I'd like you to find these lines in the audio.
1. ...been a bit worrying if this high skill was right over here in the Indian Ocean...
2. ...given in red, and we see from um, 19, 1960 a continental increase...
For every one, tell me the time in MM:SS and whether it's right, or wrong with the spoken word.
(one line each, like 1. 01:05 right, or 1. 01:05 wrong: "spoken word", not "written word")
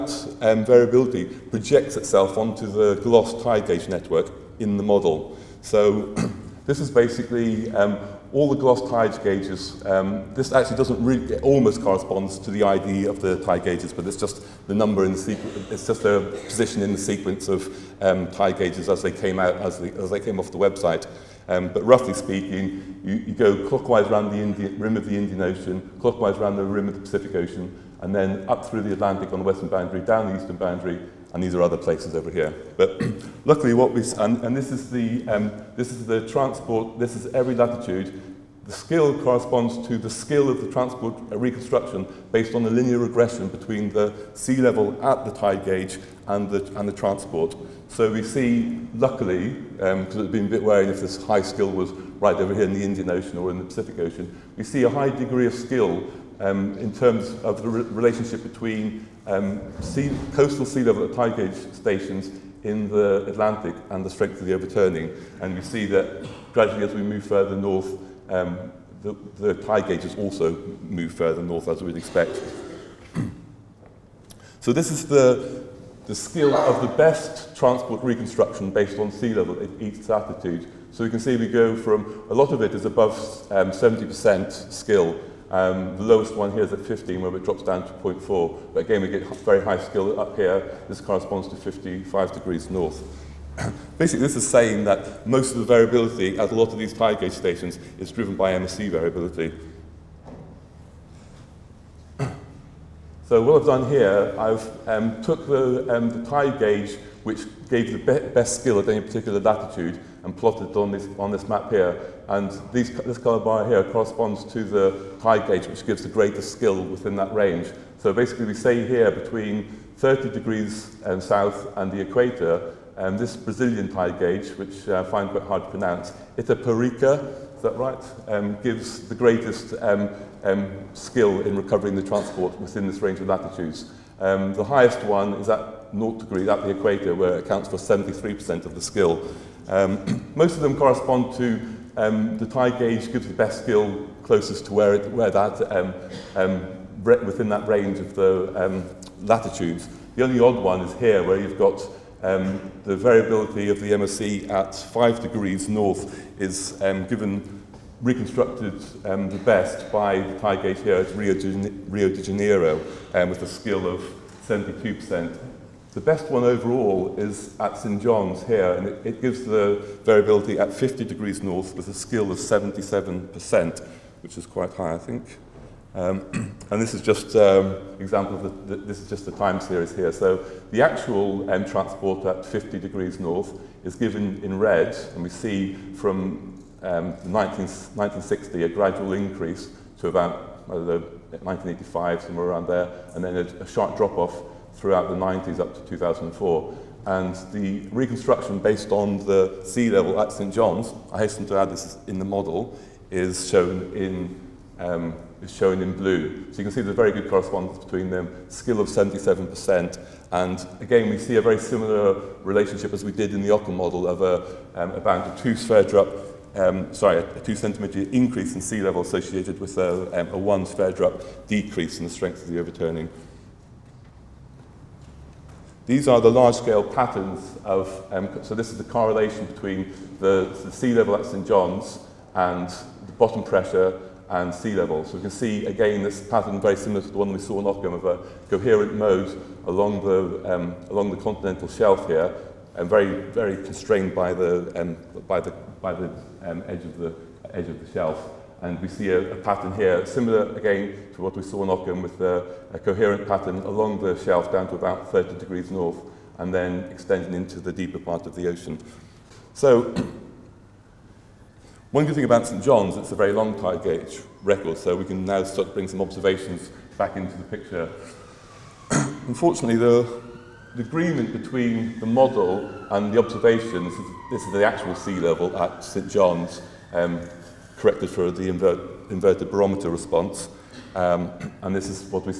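1. 00:50 right
2. 03:03 wrong: "gradual", not "continental".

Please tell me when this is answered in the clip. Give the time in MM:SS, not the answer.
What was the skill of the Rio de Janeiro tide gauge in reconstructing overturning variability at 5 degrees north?
02:44.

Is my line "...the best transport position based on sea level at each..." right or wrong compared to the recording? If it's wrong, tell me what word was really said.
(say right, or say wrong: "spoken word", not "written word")
wrong: "reconstruction", not "position".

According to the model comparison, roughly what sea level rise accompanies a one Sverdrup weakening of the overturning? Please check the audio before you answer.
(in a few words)
2 centimetres.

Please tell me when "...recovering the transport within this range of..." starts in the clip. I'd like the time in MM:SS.
02:11.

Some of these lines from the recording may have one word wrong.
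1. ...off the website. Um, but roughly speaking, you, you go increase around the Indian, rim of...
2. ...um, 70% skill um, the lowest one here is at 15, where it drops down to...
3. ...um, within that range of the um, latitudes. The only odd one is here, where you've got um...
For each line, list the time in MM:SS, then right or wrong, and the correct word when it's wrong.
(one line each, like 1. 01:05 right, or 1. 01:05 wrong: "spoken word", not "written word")
1. 00:20 wrong: "clockwise", not "increase"
2. 01:23 right
3. 02:26 right.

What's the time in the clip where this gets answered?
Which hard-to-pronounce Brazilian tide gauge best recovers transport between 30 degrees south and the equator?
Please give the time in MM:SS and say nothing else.
02:06.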